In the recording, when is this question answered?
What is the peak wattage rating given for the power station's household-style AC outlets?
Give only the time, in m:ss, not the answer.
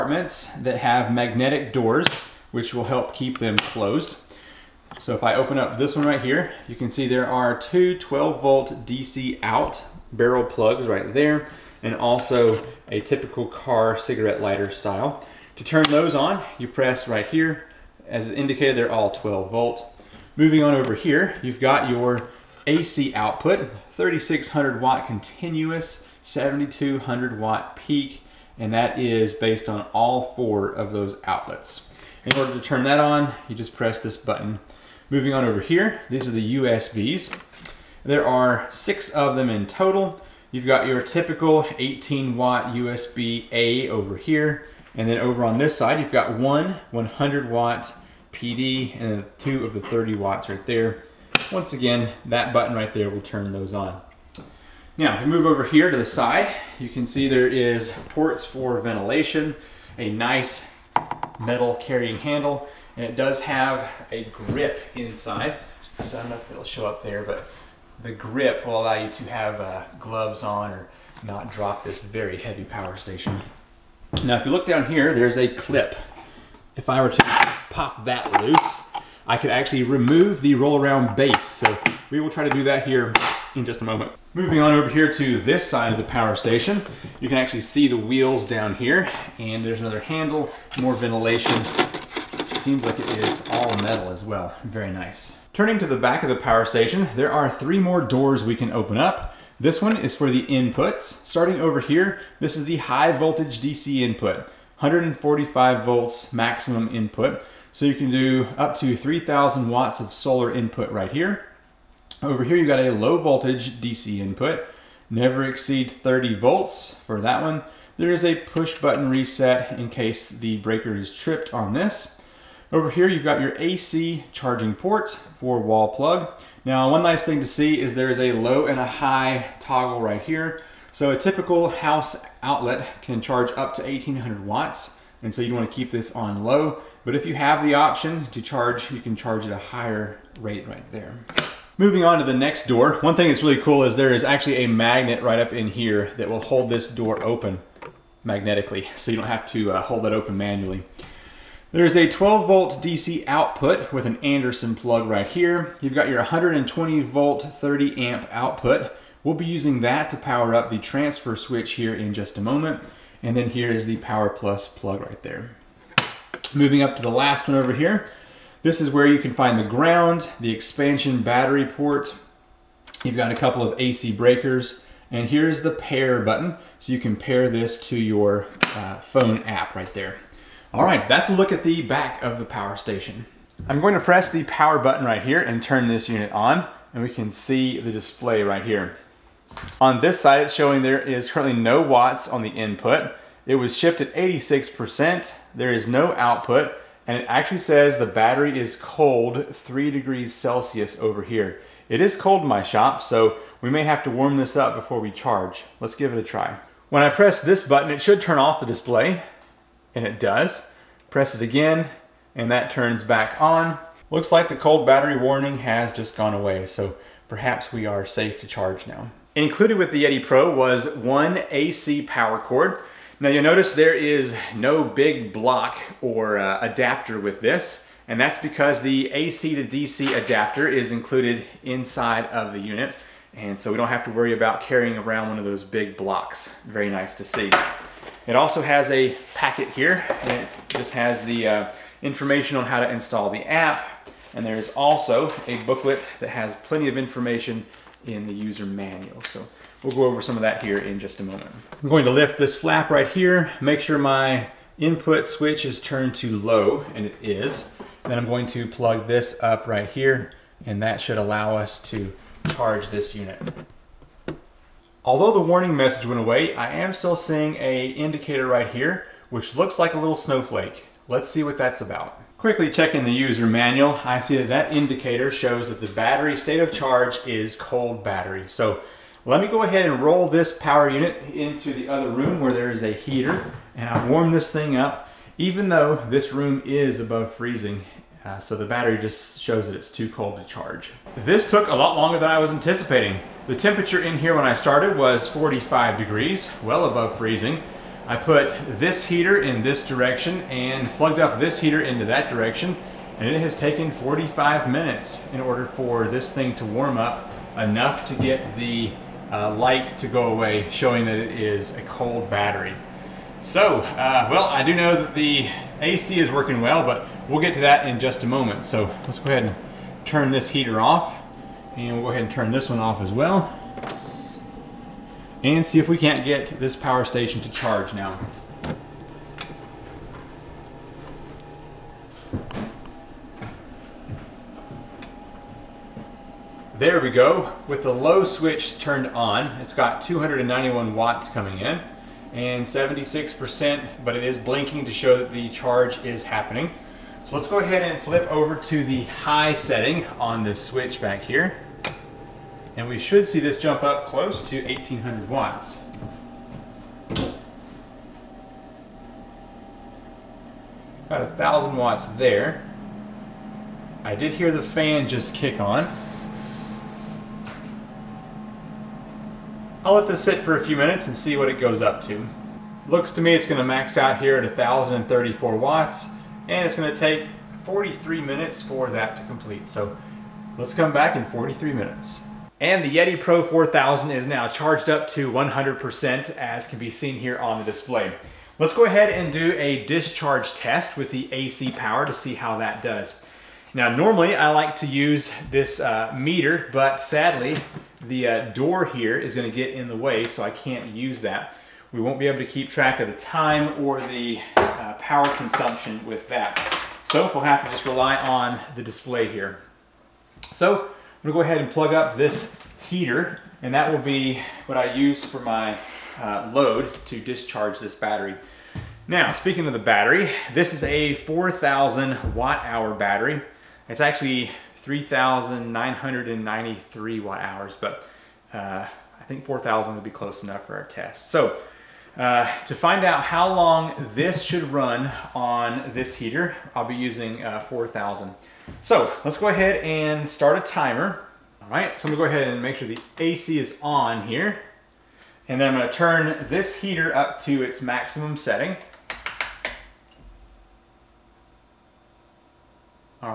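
0:26.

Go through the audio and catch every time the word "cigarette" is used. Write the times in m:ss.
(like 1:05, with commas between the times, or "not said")
0:13.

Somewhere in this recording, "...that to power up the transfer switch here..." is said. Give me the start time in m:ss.
2:39.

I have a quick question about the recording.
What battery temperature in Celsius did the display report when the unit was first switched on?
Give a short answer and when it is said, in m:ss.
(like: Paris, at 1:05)
3 degrees Celsius, at 3:19.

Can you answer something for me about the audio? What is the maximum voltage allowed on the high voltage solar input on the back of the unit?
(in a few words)
145 volts.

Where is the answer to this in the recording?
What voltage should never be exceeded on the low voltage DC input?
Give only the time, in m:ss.
1:55.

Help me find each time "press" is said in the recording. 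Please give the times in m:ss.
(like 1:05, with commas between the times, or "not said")
0:16, 0:33, 3:03, 3:27, 3:31.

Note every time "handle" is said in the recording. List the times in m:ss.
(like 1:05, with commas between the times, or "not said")
1:02, 1:29.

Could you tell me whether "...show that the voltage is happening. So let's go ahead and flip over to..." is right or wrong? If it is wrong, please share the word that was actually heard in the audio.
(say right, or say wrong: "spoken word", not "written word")
wrong: "charge", not "voltage".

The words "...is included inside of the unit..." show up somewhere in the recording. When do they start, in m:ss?
3:50.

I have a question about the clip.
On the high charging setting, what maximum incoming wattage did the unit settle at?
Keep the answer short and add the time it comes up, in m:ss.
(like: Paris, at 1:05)
1034 watts, at 6:14.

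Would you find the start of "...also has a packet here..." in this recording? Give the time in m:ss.
3:58.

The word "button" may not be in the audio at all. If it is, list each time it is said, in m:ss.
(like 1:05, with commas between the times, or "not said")
0:34, 0:52, 1:58, 2:56, 3:04, 3:27.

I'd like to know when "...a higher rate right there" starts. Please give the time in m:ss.
2:19.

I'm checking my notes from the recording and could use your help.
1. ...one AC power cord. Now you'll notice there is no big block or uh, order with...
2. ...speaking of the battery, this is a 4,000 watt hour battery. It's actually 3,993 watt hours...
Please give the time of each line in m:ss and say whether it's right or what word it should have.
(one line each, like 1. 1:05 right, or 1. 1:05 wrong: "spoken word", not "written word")
1. 3:40 wrong: "adapter", not "order"
2. 6:59 right.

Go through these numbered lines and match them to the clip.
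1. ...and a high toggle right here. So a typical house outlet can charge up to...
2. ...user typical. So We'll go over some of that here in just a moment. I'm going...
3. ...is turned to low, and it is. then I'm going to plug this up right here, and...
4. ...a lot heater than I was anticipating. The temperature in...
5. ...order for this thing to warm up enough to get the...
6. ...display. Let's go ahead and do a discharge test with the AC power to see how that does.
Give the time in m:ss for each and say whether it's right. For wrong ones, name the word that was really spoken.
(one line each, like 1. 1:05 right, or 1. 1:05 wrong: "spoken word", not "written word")
1. 2:08 right
2. 4:08 wrong: "manual", not "typical"
3. 4:15 right
4. 4:51 wrong: "longer", not "heater"
5. 5:05 right
6. 6:27 right.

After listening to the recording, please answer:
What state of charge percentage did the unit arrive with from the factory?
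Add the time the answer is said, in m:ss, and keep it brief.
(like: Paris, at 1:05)
86%, at 3:14.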